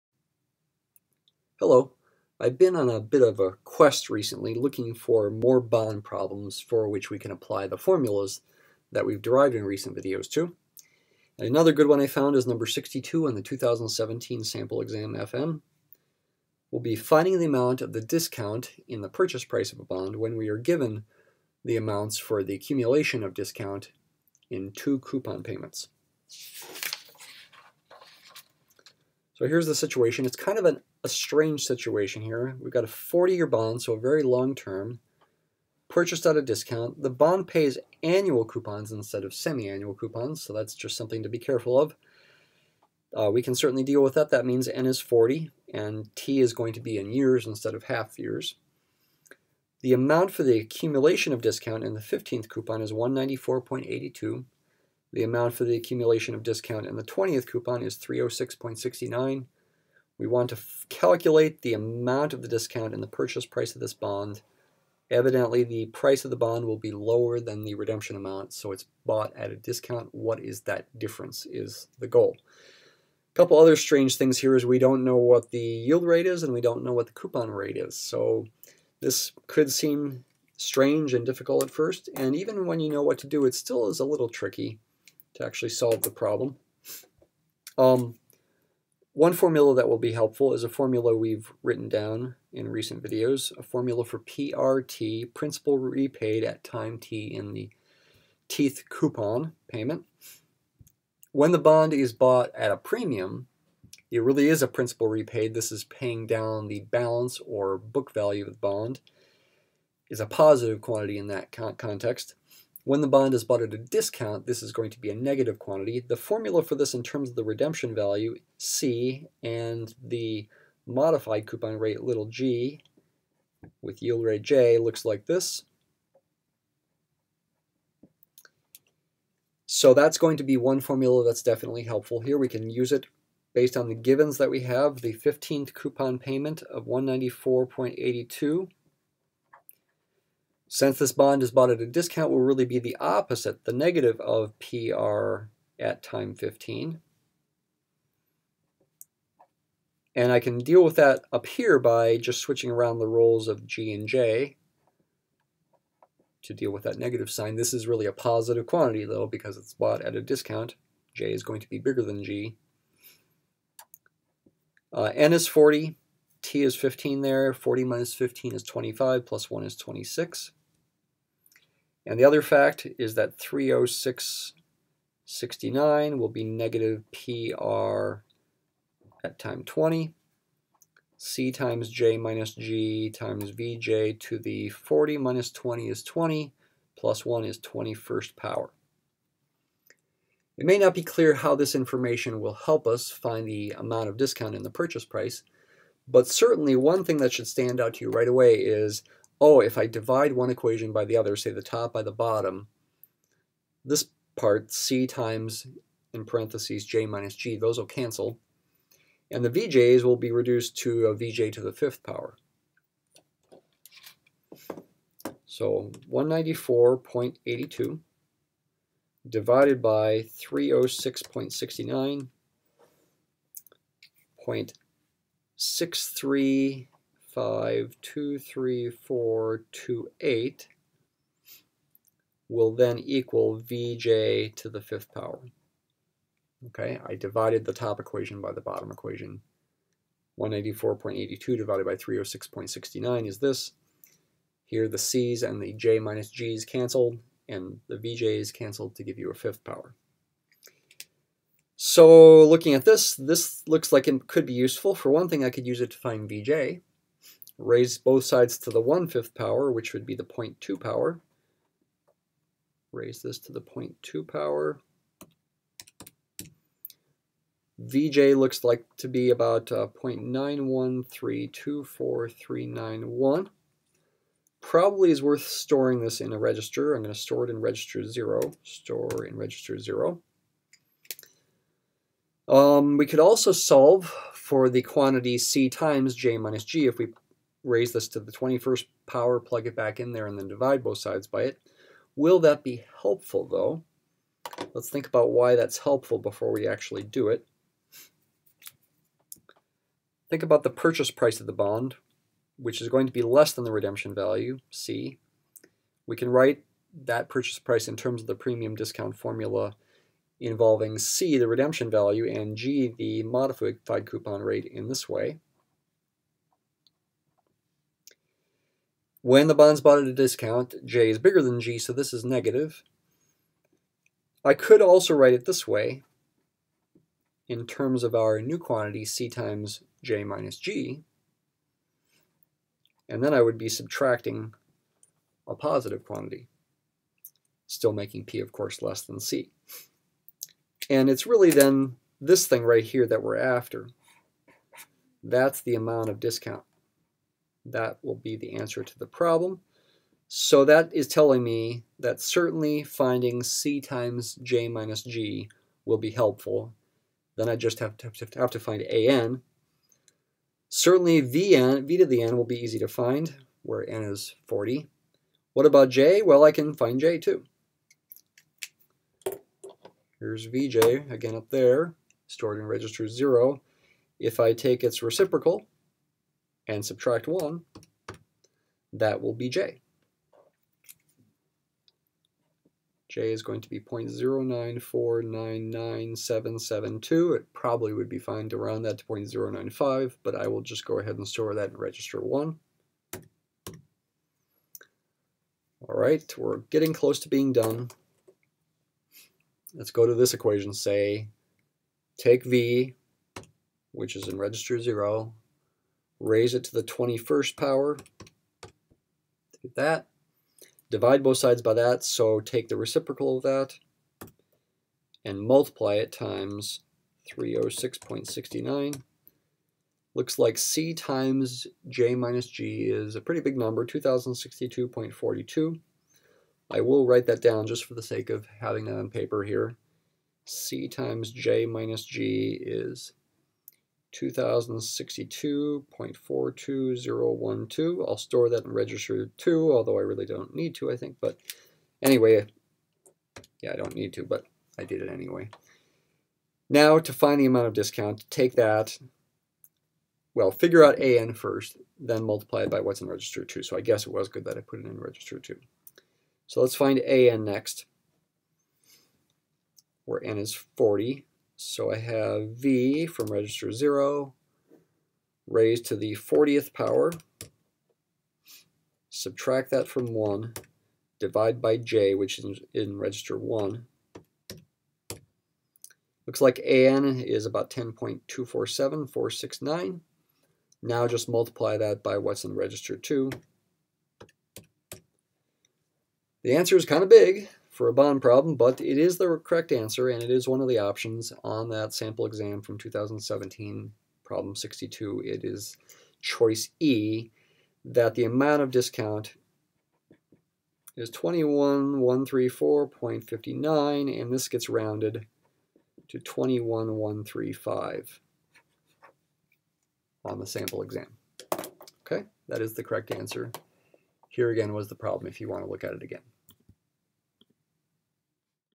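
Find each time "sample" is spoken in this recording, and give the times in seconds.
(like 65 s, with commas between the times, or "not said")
14 s, 491 s, 510 s.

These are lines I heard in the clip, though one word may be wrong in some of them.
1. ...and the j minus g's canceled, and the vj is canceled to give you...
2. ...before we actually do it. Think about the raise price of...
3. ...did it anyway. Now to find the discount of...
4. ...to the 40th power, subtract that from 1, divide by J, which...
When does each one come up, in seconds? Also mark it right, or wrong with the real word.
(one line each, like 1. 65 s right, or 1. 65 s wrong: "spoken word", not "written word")
1. 245 s right
2. 296 s wrong: "purchase", not "raise"
3. 444 s wrong: "amount", not "discount"
4. 465 s right.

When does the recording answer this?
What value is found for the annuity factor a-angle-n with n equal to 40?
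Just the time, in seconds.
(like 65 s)
477 s.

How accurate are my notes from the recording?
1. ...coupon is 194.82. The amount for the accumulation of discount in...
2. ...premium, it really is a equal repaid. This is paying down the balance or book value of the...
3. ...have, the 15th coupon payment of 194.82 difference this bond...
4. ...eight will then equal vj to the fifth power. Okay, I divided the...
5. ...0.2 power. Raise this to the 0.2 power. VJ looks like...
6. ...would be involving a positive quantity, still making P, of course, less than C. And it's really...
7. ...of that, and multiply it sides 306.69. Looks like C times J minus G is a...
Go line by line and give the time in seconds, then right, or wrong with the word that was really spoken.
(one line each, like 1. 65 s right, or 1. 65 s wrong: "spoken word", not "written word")
1. 52 s right
2. 102 s wrong: "principal", not "equal"
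3. 134 s wrong: "since", not "difference"
4. 230 s right
5. 260 s right
6. 333 s wrong: "subtracting", not "involving"
7. 413 s wrong: "times", not "sides".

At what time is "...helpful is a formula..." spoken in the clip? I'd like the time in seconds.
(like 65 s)
90 s.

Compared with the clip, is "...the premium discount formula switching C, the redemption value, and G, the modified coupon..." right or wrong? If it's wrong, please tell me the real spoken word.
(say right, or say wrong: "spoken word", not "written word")
wrong: "involving", not "switching".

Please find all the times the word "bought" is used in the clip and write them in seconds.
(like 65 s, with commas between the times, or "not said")
69 s, 102 s, 113 s, 141 s, 159 s, 319 s.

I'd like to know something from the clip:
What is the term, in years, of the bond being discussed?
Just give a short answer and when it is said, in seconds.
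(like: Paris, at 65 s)
40 years, at 32 s.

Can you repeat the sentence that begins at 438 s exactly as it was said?
I'll store that in register 2, although I really don't need to, I think.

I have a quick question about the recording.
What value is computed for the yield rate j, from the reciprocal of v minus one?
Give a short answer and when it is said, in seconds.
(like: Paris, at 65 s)
0.094997772, at 383 s.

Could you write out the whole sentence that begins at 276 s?
I'm going to store it in register 0.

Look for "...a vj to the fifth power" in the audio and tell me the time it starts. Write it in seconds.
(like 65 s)
211 s.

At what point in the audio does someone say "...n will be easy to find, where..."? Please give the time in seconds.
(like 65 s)
362 s.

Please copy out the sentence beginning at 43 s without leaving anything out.
Uh, we can certainly deal with that.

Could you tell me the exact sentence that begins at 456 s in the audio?
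So let's find AN next, where N is 40.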